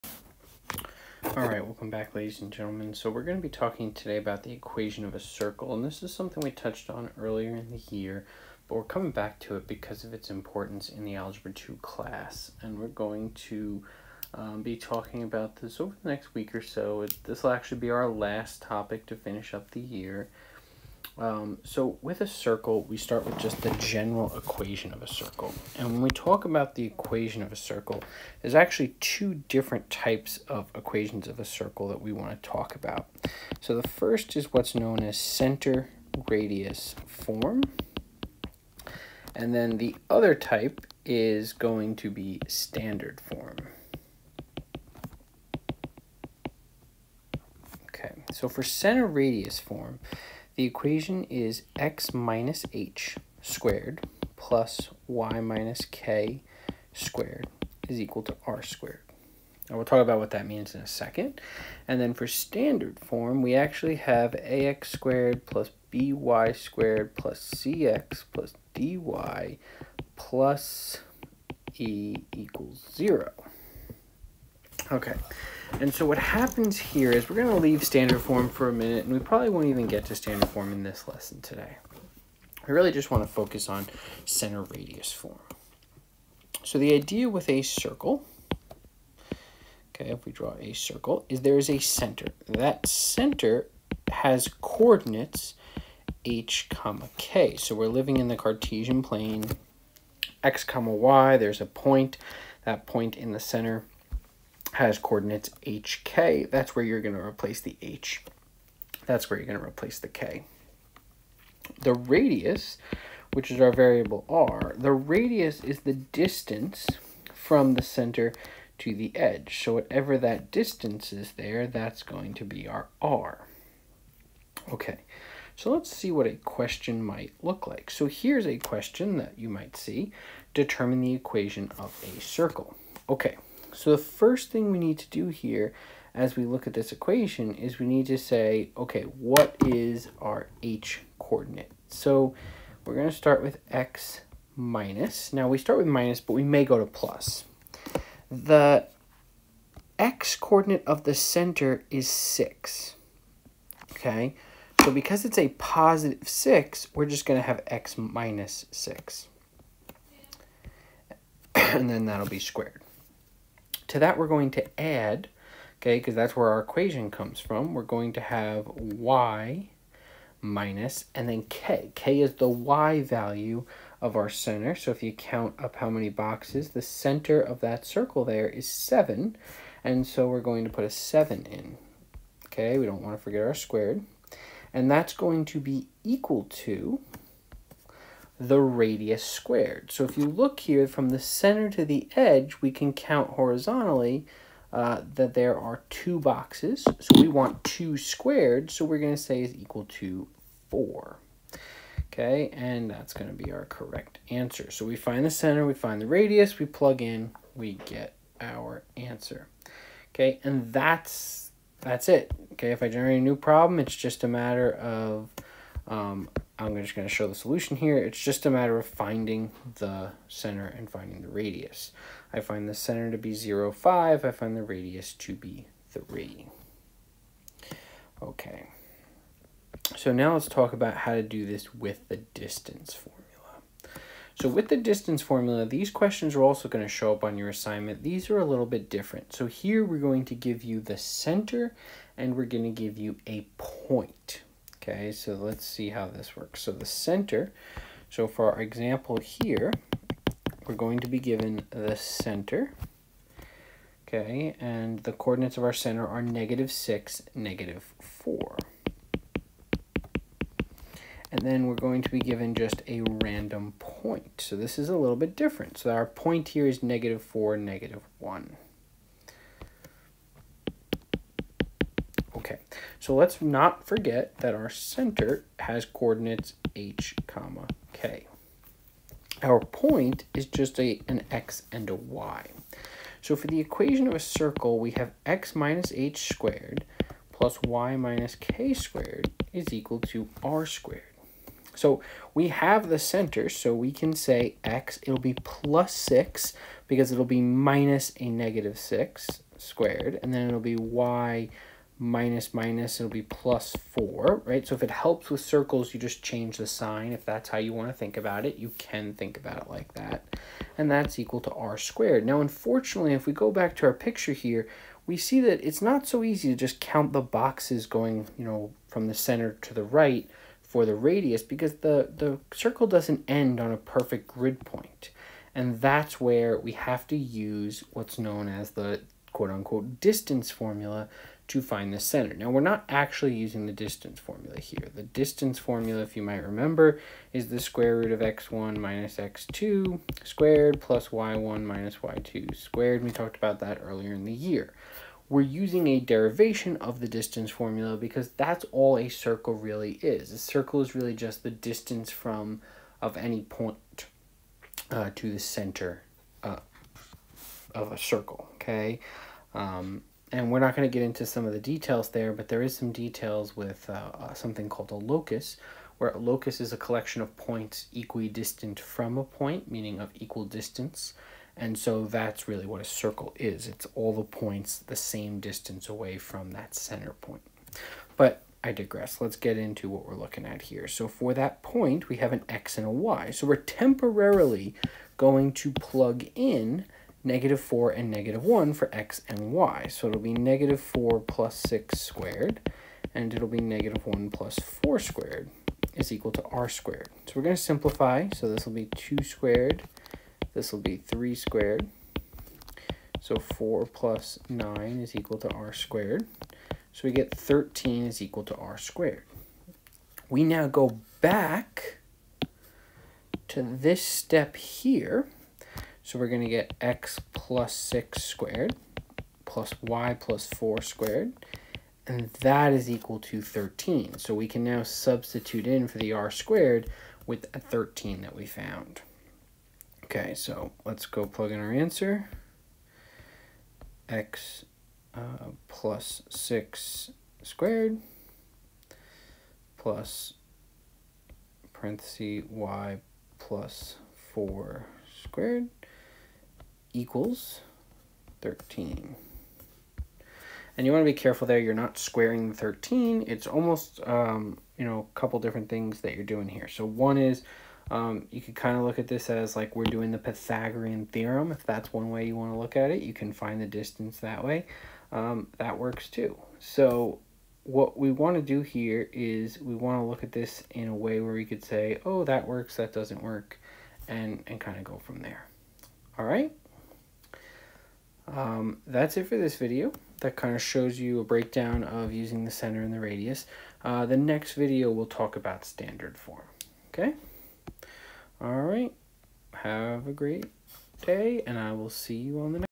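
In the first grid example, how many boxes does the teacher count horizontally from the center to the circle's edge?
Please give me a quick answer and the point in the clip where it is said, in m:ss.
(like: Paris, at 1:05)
2, at 3:15.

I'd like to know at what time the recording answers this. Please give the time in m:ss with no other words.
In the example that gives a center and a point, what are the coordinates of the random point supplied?
4:26.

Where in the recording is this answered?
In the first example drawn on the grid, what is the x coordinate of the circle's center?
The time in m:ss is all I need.
2:28.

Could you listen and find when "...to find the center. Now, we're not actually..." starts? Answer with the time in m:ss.
5:31.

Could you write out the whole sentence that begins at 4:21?
And then we're going to be given just a random point.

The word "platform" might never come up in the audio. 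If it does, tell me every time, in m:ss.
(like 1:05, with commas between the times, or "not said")
not said.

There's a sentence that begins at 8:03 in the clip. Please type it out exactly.
Uh, the next video we'll talk about standard form.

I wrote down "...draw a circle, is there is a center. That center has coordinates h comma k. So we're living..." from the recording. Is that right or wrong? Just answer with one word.
right.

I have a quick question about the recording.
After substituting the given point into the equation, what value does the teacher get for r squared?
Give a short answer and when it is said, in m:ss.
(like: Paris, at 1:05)
13, at 6:47.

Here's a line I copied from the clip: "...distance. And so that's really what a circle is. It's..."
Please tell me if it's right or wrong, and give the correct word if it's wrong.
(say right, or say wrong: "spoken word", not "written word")
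right.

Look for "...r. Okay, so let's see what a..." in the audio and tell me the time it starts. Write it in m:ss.
2:03.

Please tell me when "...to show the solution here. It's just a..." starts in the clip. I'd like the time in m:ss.
3:37.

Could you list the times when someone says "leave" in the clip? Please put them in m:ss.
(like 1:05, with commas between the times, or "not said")
1:17.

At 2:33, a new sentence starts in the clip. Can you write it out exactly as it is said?
Okay, so because it's a positive 6, we're just going to have x minus 6.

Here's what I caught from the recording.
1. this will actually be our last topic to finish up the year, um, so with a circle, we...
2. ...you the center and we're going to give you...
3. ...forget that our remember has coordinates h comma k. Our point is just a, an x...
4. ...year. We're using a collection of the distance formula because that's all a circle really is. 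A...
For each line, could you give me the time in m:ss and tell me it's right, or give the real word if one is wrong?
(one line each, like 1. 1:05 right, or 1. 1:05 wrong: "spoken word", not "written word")
1. 0:17 right
2. 4:00 right
3. 4:33 wrong: "center", not "remember"
4. 5:44 wrong: "derivation", not "collection".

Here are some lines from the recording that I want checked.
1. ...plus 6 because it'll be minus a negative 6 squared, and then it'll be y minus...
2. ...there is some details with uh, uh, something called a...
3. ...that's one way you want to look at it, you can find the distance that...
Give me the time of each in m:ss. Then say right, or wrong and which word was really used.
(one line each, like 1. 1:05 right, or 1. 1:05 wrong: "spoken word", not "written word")
1. 4:55 right
2. 6:02 right
3. 7:41 right.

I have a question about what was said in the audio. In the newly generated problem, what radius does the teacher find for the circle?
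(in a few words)
3.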